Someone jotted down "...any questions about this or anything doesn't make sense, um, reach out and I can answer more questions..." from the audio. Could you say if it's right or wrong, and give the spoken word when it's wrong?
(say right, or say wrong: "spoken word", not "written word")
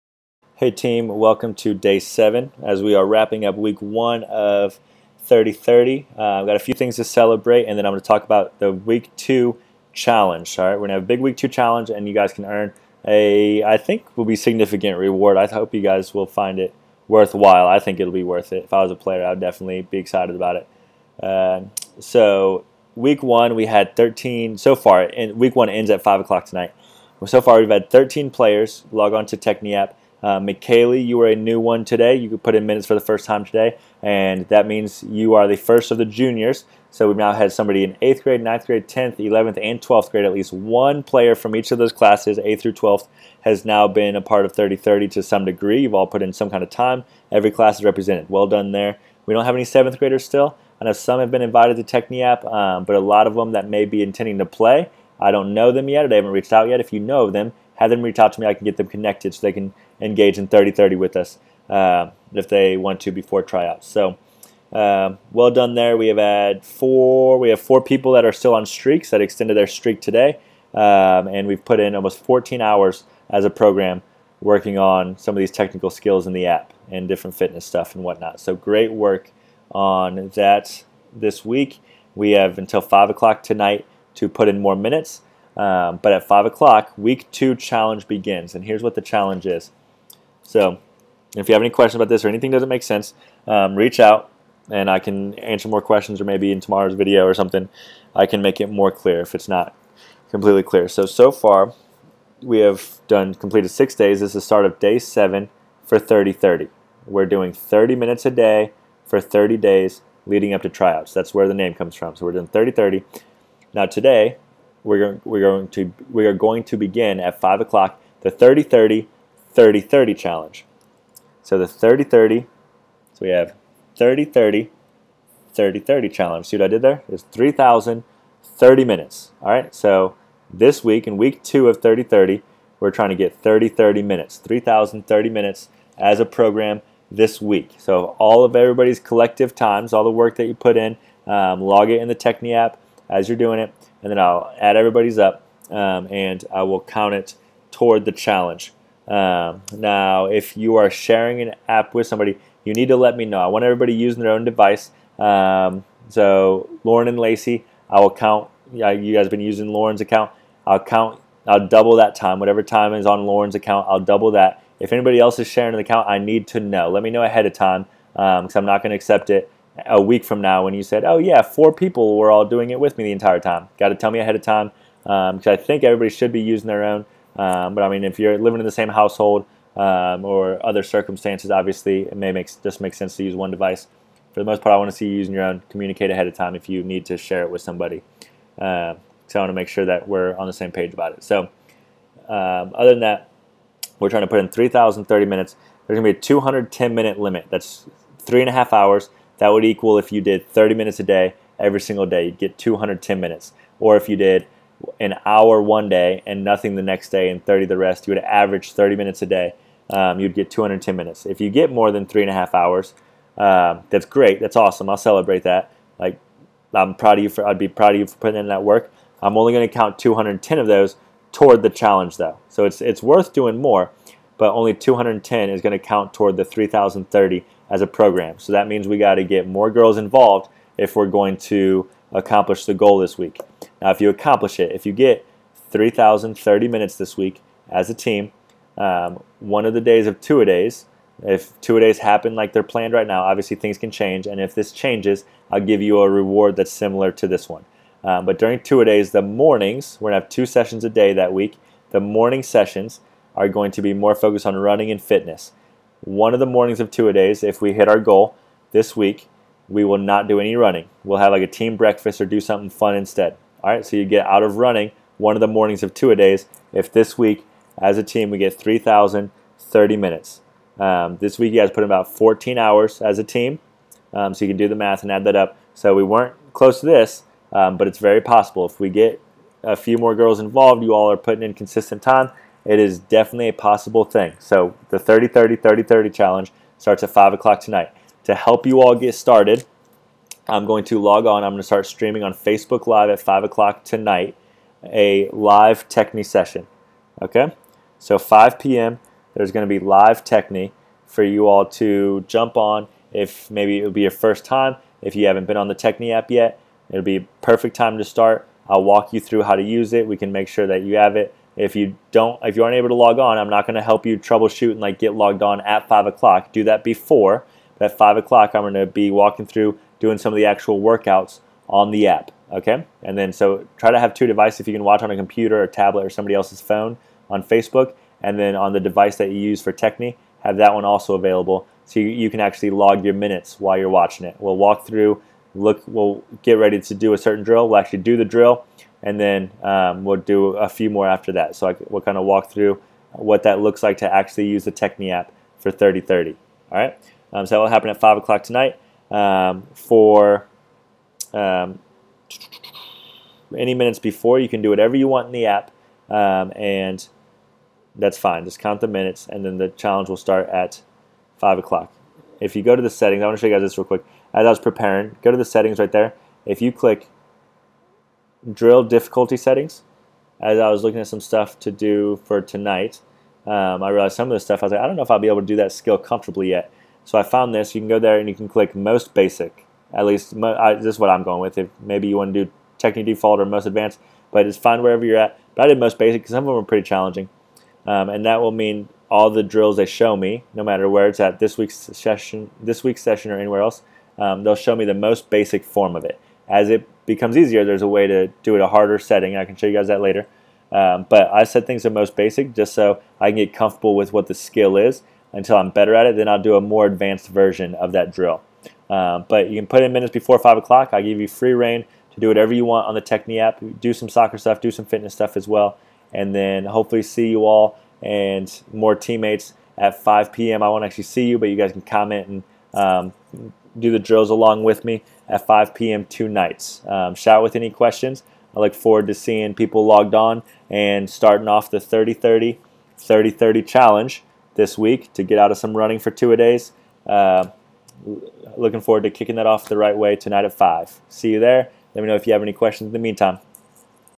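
right.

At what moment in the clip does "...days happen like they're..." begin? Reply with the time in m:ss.
4:01.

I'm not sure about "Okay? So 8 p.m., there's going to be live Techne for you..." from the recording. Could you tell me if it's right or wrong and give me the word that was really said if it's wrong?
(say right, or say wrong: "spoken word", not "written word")
wrong: "5", not "8".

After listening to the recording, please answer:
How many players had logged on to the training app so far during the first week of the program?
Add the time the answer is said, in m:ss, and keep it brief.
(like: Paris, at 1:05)
13, at 0:27.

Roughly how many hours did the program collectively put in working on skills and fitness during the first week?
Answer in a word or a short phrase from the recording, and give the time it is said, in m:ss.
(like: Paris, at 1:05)
14 hours, at 1:11.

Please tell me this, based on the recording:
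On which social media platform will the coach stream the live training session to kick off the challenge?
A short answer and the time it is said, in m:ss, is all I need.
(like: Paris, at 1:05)
Facebook Live, at 4:52.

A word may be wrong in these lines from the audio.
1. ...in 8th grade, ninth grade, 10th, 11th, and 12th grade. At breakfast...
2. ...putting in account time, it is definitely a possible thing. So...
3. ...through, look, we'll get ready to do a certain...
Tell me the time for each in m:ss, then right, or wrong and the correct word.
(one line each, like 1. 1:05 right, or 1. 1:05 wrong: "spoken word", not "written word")
1. 0:37 wrong: "least", not "breakfast"
2. 4:41 wrong: "consistent", not "account"
3. 5:34 right.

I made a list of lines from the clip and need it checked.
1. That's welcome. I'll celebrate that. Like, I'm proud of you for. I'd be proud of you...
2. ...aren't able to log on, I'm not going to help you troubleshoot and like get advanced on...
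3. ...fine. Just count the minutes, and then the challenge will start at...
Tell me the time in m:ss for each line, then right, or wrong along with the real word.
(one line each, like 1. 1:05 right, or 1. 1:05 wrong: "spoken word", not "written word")
1. 3:34 wrong: "awesome", not "welcome"
2. 5:12 wrong: "logged", not "advanced"
3. 5:58 right.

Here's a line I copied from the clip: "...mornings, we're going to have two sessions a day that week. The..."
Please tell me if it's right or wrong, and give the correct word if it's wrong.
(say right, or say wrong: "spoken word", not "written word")
right.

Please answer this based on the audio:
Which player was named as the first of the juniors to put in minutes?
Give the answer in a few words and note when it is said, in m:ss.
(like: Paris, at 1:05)
McKaylee, at 0:30.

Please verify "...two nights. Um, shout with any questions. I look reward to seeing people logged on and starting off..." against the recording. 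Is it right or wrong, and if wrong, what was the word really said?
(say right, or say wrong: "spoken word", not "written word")
wrong: "forward", not "reward".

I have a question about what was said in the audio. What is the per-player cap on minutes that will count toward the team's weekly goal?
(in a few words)
210 minutes.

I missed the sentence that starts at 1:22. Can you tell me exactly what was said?
We have until five o'clock tonight to put in more minutes.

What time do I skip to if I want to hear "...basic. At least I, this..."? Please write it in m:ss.
6:19.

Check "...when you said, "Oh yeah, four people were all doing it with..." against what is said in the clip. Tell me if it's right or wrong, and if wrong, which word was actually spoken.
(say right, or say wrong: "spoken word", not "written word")
right.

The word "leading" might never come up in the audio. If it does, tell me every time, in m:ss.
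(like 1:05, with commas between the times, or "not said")
1:50.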